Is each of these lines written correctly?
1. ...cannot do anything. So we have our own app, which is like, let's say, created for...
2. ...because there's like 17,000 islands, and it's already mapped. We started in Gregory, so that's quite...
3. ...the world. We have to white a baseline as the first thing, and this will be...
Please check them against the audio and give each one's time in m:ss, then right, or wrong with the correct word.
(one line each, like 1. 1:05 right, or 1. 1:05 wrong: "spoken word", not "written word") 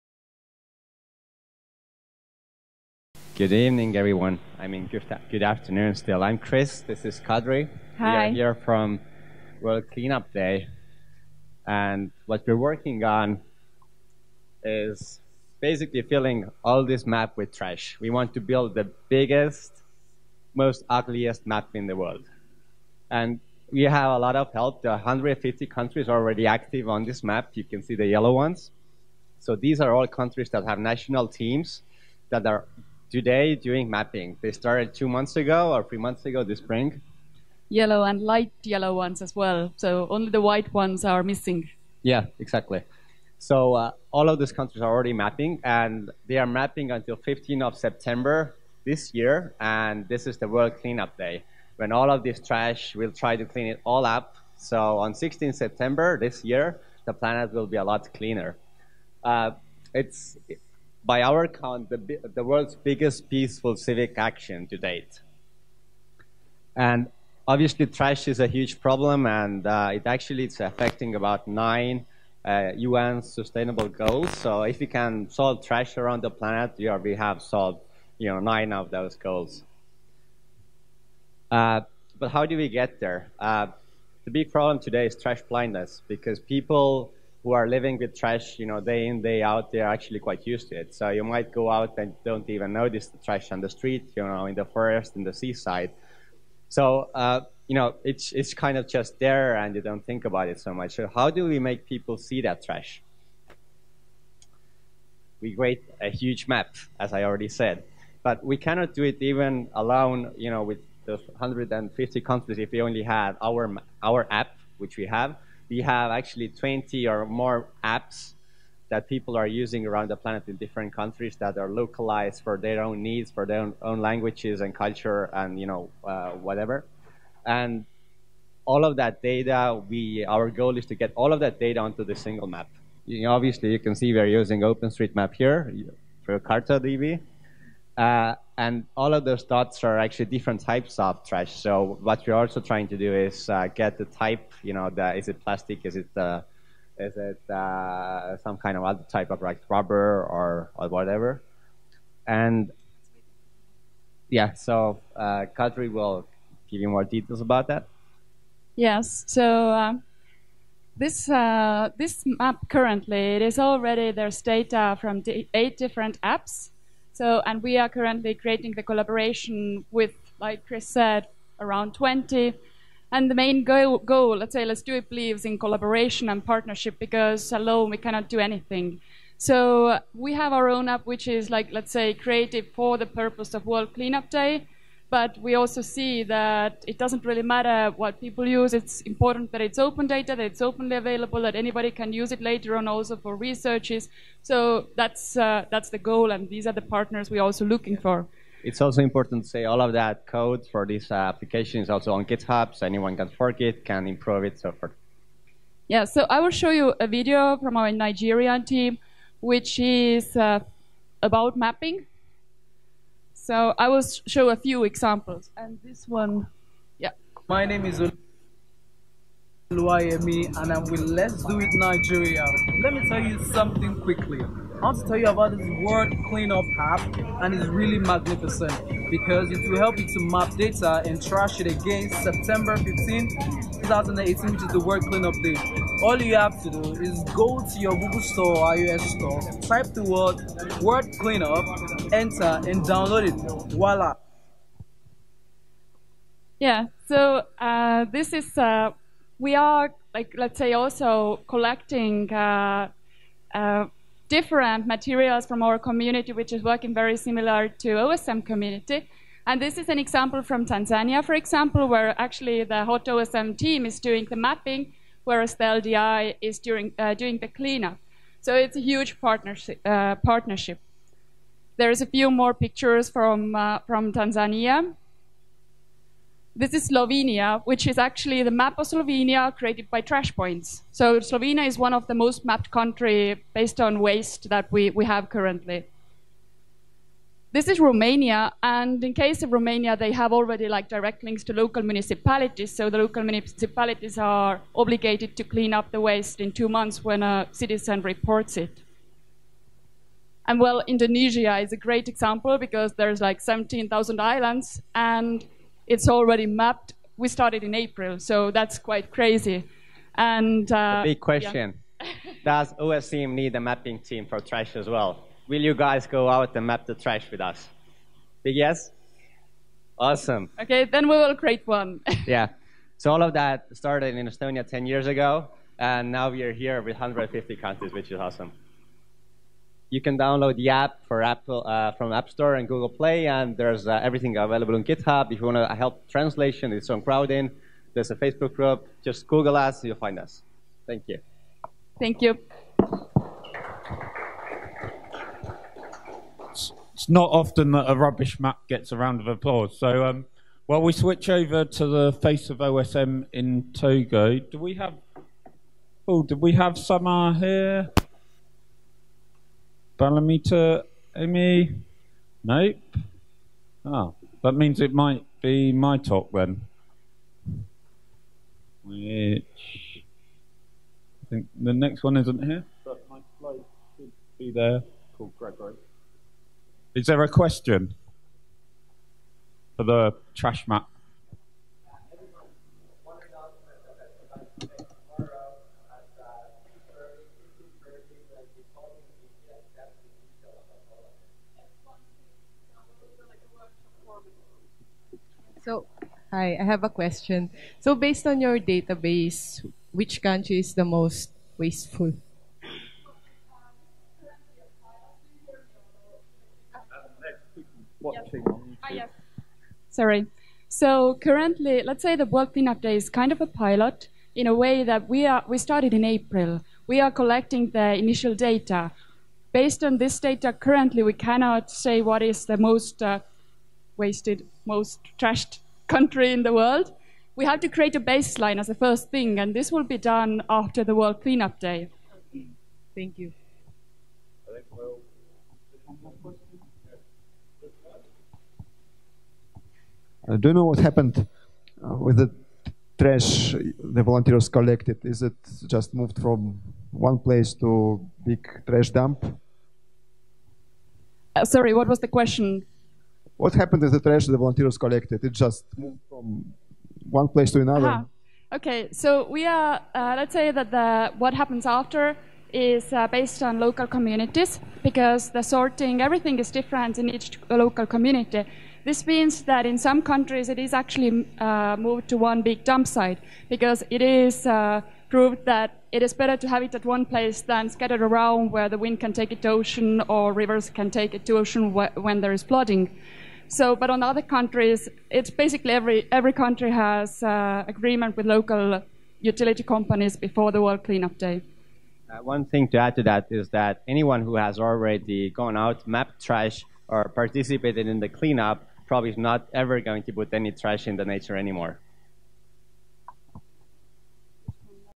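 1. 2:57 right
2. 5:02 wrong: "April", not "Gregory"
3. 7:06 wrong: "create", not "white".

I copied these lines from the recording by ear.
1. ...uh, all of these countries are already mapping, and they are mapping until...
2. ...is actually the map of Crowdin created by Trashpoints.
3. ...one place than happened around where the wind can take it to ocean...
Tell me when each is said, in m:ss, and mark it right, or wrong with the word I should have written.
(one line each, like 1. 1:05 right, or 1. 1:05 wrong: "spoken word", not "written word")
1. 0:43 right
2. 4:37 wrong: "Slovenia", not "Crowdin"
3. 7:56 wrong: "scattered", not "happened".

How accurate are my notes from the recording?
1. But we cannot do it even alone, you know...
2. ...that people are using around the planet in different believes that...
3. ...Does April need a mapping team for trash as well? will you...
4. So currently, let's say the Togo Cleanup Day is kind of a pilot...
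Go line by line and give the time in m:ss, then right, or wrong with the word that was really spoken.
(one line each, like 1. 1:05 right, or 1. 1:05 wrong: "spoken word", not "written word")
1. 1:48 right
2. 1:58 wrong: "countries", not "believes"
3. 5:12 wrong: "OSM", not "April"
4. 6:50 wrong: "World", not "Togo".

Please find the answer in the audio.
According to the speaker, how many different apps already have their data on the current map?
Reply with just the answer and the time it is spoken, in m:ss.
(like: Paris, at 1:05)
8, at 2:45.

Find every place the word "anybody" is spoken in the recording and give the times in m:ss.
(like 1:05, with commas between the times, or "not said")
3:11.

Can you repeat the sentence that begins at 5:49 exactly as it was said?
So um, while we switch over to the face of OSM in Togo, do we have?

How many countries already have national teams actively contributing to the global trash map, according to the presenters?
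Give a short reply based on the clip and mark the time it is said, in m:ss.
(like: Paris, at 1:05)
150, at 0:24.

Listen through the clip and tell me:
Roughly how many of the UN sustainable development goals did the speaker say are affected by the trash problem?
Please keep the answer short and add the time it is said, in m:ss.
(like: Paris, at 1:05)
9, at 1:11.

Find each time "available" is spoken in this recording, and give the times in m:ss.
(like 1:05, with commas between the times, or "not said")
3:10, 5:34.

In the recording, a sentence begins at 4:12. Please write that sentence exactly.
Uh, uh different materials from our community, which is working very similar to OSM community.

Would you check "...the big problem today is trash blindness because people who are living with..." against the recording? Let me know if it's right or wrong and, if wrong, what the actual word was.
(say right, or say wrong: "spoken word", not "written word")
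right.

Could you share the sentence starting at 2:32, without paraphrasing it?
And yeah, so uh, Kadri will give you more details about that.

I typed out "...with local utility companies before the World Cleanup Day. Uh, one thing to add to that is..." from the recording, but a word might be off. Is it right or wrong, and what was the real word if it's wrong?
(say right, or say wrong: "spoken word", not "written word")
right.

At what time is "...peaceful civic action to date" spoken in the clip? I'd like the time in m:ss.
1:03.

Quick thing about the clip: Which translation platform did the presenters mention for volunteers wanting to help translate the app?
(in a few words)
Crowdin.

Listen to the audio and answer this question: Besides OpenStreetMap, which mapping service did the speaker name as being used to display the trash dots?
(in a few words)
CartoDB.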